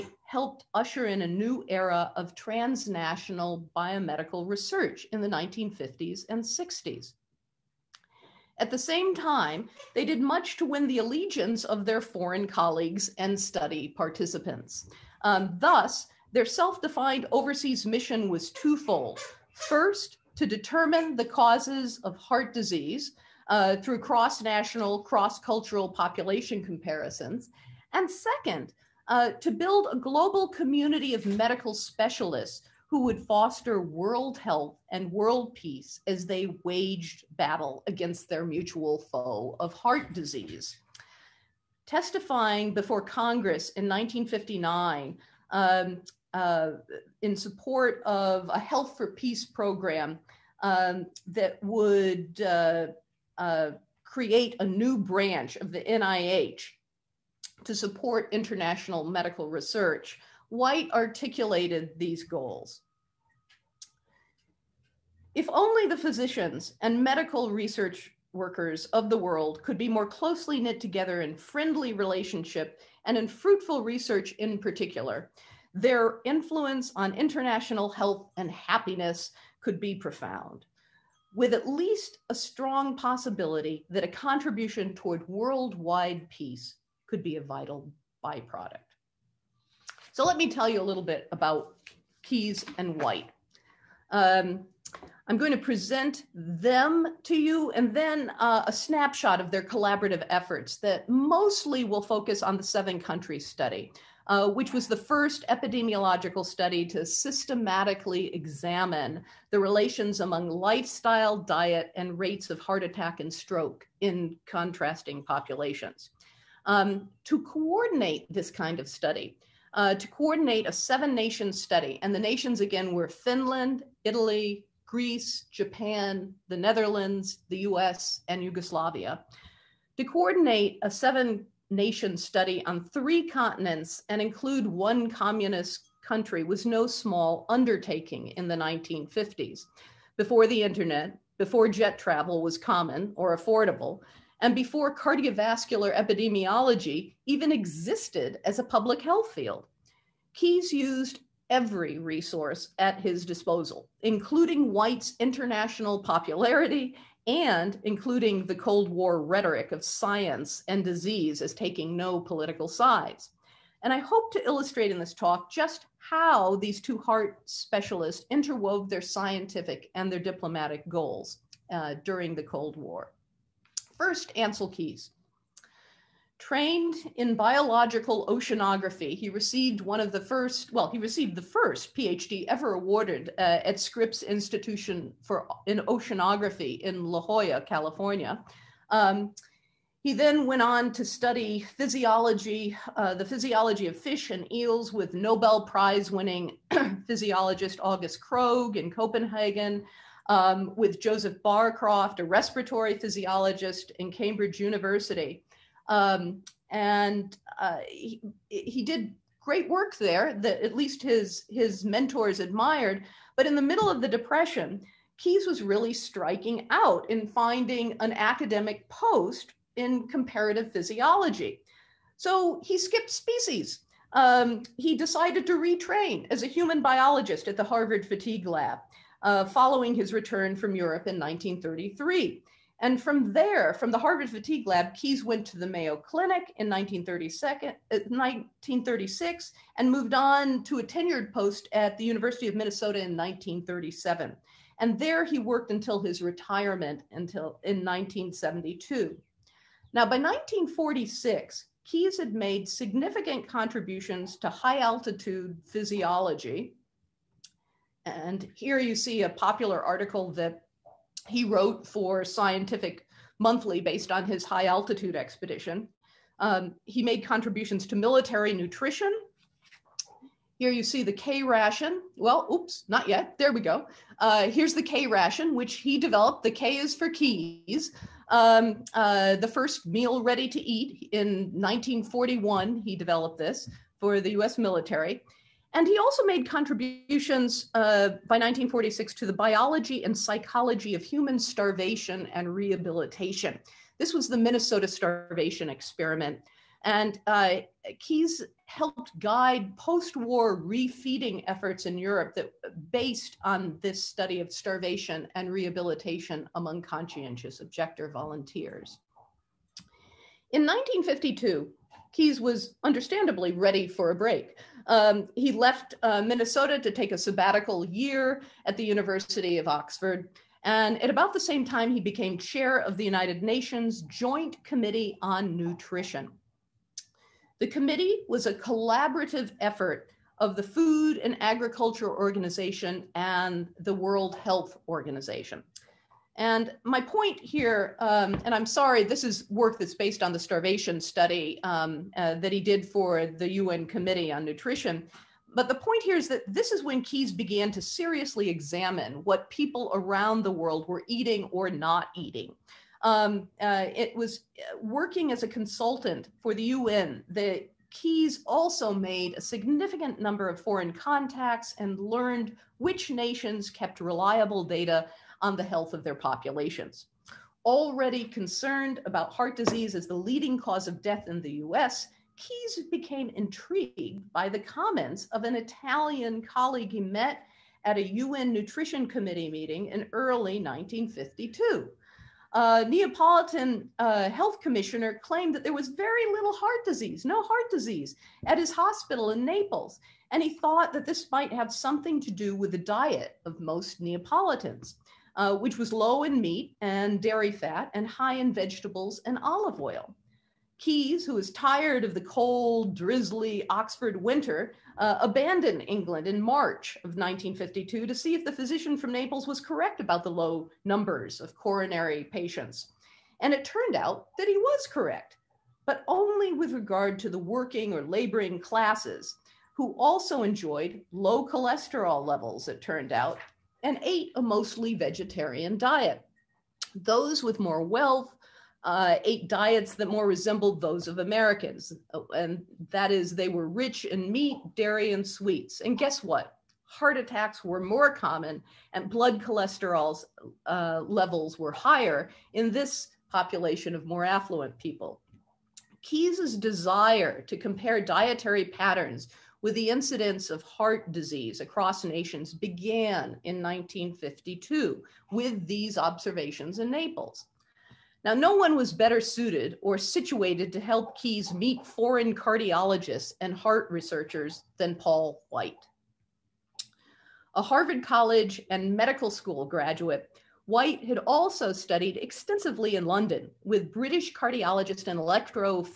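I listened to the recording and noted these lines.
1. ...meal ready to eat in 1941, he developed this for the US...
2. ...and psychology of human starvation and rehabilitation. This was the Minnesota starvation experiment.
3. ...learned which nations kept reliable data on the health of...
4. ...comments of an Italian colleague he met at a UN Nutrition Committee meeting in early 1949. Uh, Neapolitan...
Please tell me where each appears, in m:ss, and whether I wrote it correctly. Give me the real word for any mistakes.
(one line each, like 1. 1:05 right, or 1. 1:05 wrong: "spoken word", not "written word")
1. 4:39 right
2. 4:50 right
3. 6:01 right
4. 6:14 wrong: "1952", not "1949".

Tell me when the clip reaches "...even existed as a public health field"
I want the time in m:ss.
2:27.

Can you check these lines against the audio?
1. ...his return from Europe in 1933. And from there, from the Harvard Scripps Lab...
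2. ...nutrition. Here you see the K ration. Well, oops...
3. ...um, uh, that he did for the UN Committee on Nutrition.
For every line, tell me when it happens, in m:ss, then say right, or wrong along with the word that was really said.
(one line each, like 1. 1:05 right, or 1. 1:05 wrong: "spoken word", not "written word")
1. 3:49 wrong: "Fatigue", not "Scripps"
2. 4:28 right
3. 5:41 right.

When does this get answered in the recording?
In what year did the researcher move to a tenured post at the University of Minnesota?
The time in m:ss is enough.
4:03.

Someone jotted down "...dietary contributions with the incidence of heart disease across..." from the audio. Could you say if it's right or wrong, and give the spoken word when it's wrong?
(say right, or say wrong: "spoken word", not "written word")
wrong: "patterns", not "contributions".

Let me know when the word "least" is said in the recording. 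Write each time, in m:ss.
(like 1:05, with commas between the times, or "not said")
1:21, 3:30.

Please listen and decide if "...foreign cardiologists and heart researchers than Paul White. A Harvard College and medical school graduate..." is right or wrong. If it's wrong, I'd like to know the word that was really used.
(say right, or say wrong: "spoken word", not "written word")
right.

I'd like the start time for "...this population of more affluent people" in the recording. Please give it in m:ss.
7:22.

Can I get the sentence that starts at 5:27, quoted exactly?
The committee was a collaborative effort of the Food and Agriculture Organization and the World Health Organization.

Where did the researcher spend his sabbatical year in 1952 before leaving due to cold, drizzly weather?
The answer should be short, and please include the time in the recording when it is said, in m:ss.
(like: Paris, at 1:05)
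University of Oxford, at 5:18.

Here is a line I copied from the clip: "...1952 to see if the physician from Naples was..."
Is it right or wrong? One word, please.
right.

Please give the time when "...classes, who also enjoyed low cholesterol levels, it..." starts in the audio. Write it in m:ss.
6:58.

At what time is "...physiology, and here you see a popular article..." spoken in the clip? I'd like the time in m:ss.
4:15.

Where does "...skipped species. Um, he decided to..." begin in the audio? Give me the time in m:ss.
3:42.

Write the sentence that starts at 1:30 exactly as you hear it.
So let me tell you a little bit about Keys and White.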